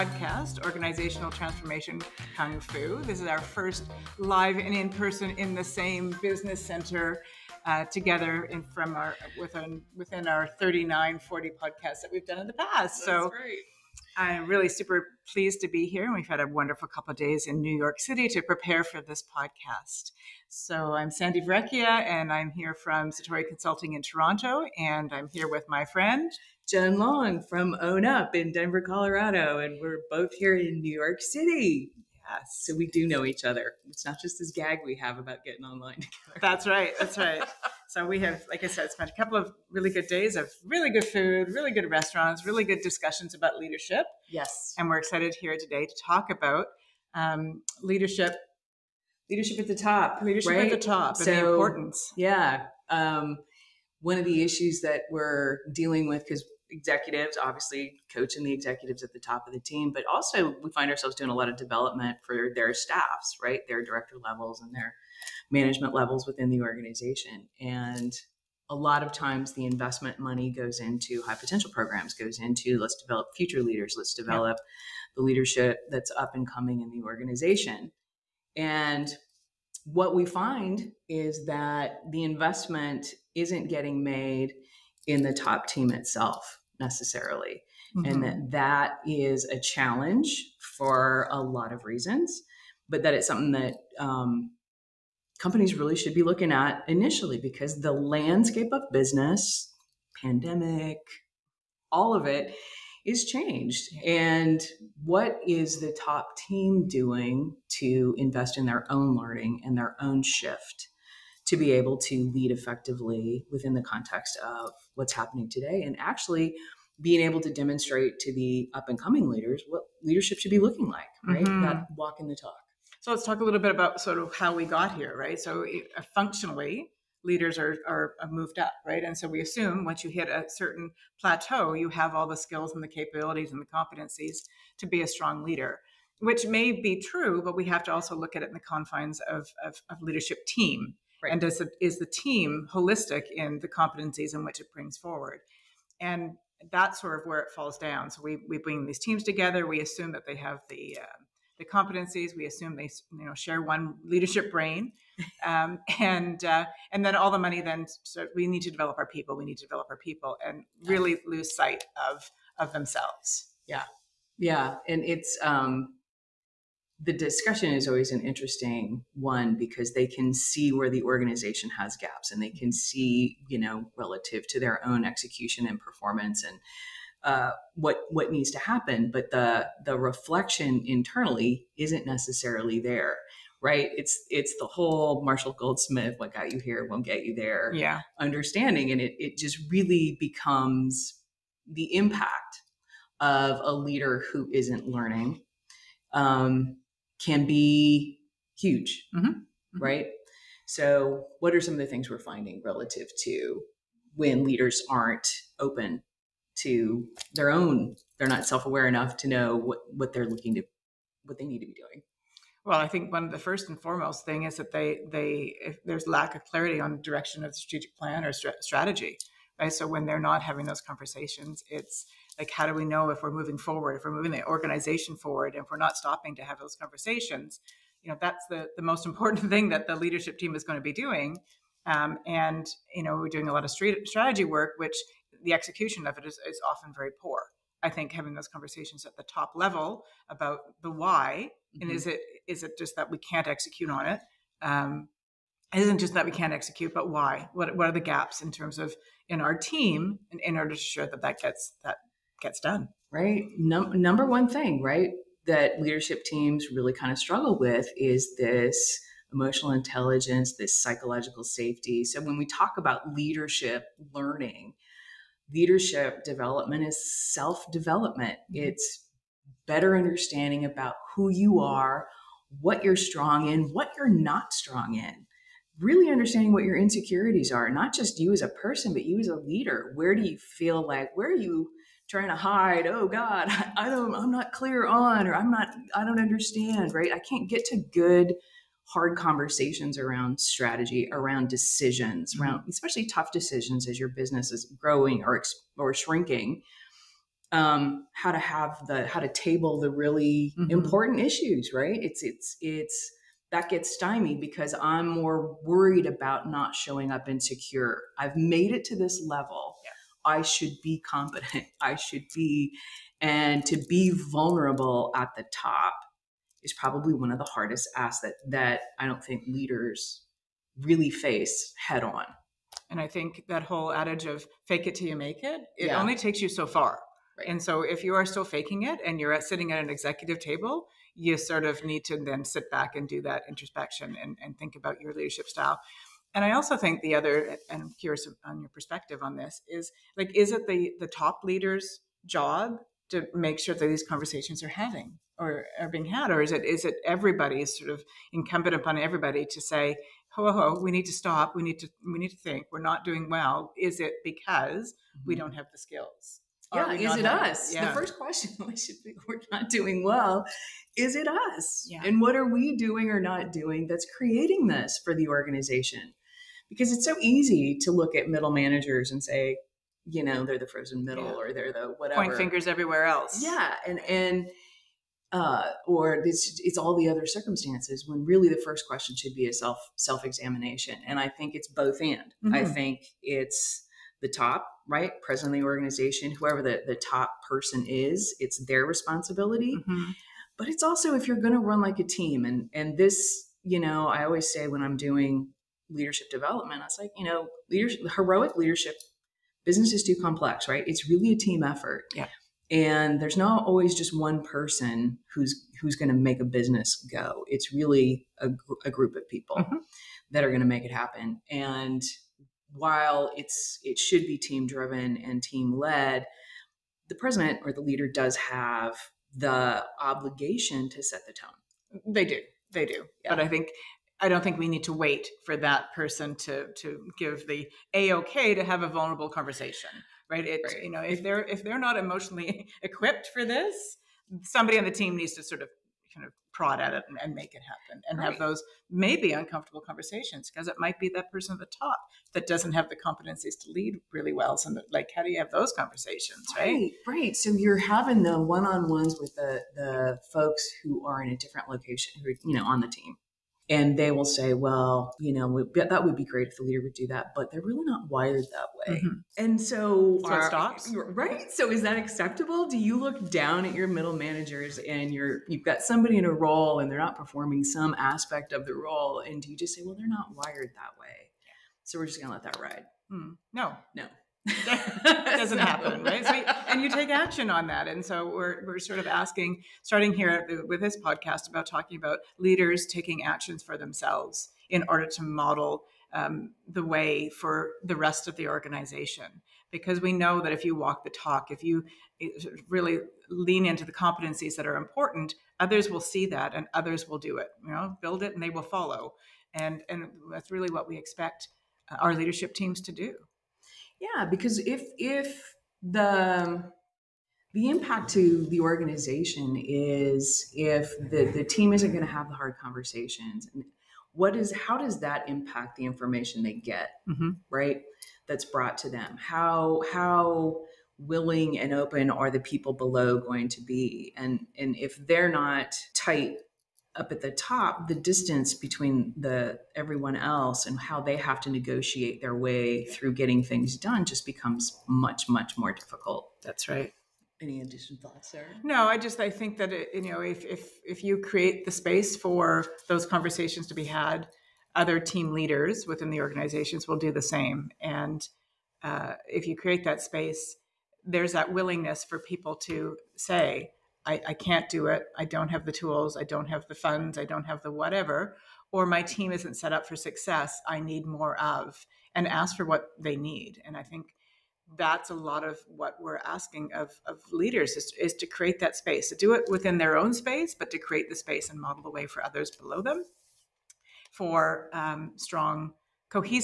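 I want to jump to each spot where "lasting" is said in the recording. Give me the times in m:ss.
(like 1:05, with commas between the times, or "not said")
not said.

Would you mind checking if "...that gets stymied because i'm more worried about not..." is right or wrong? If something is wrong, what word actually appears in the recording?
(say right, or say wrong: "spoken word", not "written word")
right.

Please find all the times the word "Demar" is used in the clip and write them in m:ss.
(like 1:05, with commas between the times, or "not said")
not said.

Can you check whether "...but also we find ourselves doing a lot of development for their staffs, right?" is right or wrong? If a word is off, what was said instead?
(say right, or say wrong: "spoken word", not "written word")
right.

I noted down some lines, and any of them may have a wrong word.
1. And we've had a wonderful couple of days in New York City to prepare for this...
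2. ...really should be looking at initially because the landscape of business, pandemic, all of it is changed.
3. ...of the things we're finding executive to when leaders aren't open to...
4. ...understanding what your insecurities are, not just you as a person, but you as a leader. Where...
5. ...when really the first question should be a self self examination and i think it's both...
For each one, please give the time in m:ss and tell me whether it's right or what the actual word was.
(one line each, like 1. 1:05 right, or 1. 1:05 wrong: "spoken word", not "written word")
1. 0:16 right
2. 1:35 right
3. 3:21 wrong: "relative", not "executive"
4. 4:36 right
5. 6:18 right.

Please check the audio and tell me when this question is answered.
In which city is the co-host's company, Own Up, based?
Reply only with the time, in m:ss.
0:28.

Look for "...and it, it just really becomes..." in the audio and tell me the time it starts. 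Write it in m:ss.
3:08.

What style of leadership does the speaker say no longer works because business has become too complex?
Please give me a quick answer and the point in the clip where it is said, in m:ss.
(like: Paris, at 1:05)
heroic leadership, at 6:38.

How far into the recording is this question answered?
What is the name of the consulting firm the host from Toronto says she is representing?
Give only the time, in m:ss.
0:23.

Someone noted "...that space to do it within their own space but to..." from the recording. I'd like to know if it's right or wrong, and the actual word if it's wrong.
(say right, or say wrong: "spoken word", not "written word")
right.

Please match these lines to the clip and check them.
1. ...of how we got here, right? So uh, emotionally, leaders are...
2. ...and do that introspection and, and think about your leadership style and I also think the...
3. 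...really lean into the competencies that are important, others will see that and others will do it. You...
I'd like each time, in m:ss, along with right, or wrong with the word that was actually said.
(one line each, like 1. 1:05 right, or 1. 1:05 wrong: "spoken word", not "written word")
1. 2:04 wrong: "functionally", not "emotionally"
2. 5:32 right
3. 8:12 right.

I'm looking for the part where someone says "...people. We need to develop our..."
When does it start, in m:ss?
2:39.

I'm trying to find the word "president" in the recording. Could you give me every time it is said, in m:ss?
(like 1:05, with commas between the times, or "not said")
6:25, 6:57.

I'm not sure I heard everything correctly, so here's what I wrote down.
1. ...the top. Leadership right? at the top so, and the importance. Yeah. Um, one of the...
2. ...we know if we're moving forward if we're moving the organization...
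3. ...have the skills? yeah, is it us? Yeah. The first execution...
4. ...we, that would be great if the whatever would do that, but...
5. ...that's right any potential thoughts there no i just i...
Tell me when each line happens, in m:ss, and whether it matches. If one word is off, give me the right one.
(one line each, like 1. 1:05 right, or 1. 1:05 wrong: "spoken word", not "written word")
1. 0:49 right
2. 3:42 right
3. 5:55 wrong: "question", not "execution"
4. 7:35 wrong: "leader", not "whatever"
5. 8:56 wrong: "additional", not "potential".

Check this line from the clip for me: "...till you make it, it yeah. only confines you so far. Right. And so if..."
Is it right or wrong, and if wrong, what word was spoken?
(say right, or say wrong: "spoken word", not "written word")
wrong: "takes", not "confines".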